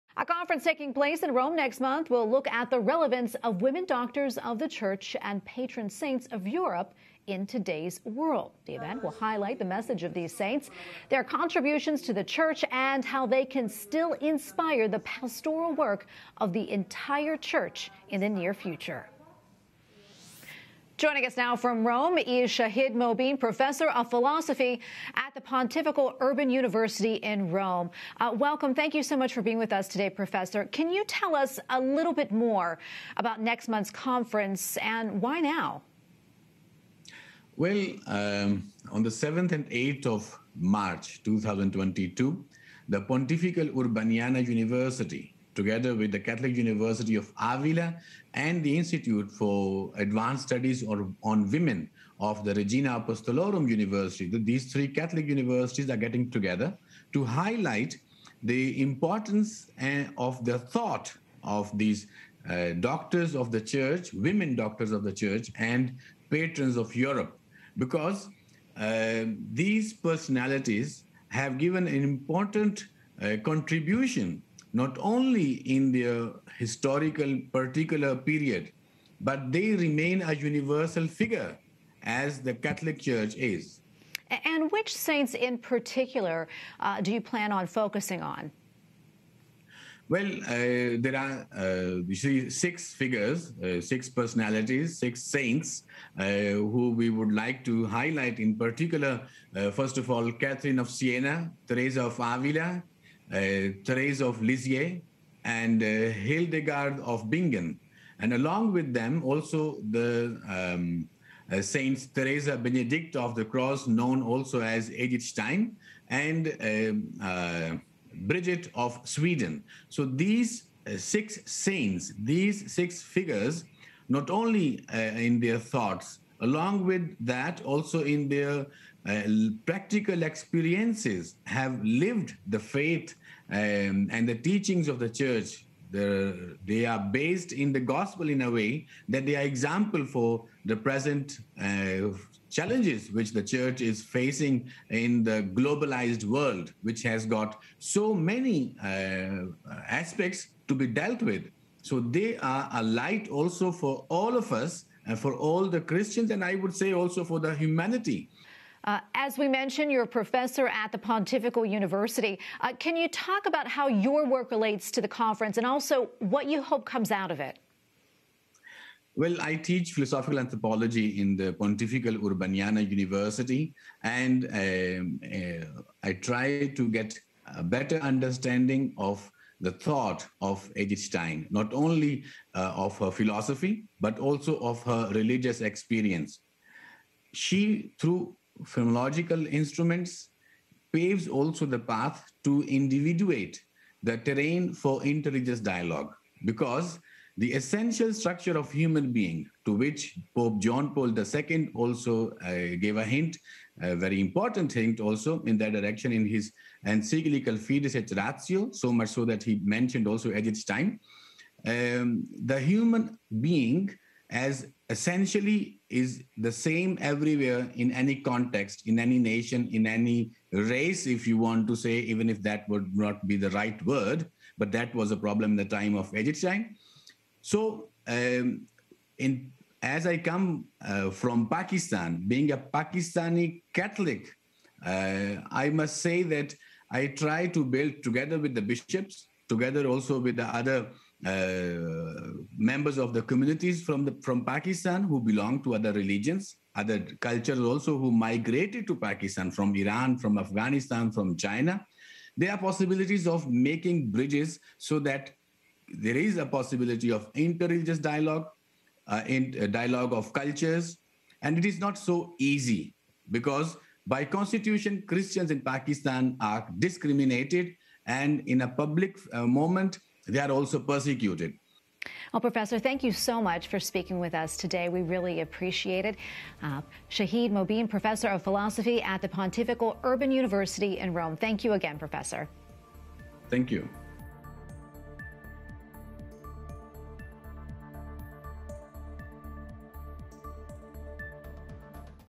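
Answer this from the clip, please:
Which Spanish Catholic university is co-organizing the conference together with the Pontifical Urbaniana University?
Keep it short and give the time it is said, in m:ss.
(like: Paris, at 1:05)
Catholic University of Avila, at 0:46.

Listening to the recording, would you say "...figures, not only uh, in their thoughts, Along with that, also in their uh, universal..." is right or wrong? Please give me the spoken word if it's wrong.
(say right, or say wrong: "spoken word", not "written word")
wrong: "practical", not "universal".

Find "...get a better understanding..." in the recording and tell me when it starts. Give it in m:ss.
2:56.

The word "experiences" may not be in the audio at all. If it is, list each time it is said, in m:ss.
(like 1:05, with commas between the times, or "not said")
2:10, 3:05.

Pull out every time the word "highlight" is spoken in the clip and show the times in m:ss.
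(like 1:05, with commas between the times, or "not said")
0:09, 0:57, 1:37.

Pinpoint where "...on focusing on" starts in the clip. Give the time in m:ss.
1:27.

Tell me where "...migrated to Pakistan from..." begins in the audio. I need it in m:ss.
4:08.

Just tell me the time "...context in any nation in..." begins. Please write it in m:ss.
3:38.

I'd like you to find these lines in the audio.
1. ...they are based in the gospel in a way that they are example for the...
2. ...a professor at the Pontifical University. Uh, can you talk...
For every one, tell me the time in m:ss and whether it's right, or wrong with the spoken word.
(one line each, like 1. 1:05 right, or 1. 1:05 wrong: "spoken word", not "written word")
1. 2:16 right
2. 2:40 right.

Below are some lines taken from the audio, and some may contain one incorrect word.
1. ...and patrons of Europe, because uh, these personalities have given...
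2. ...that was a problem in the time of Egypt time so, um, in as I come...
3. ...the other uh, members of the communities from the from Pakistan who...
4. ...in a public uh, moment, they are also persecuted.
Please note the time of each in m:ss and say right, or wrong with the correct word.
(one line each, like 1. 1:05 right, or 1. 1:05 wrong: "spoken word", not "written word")
1. 1:05 right
2. 3:44 right
3. 4:00 right
4. 4:28 right.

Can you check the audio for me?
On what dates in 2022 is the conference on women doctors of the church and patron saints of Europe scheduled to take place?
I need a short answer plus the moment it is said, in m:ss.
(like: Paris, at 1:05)
7 and 8 March, at 0:39.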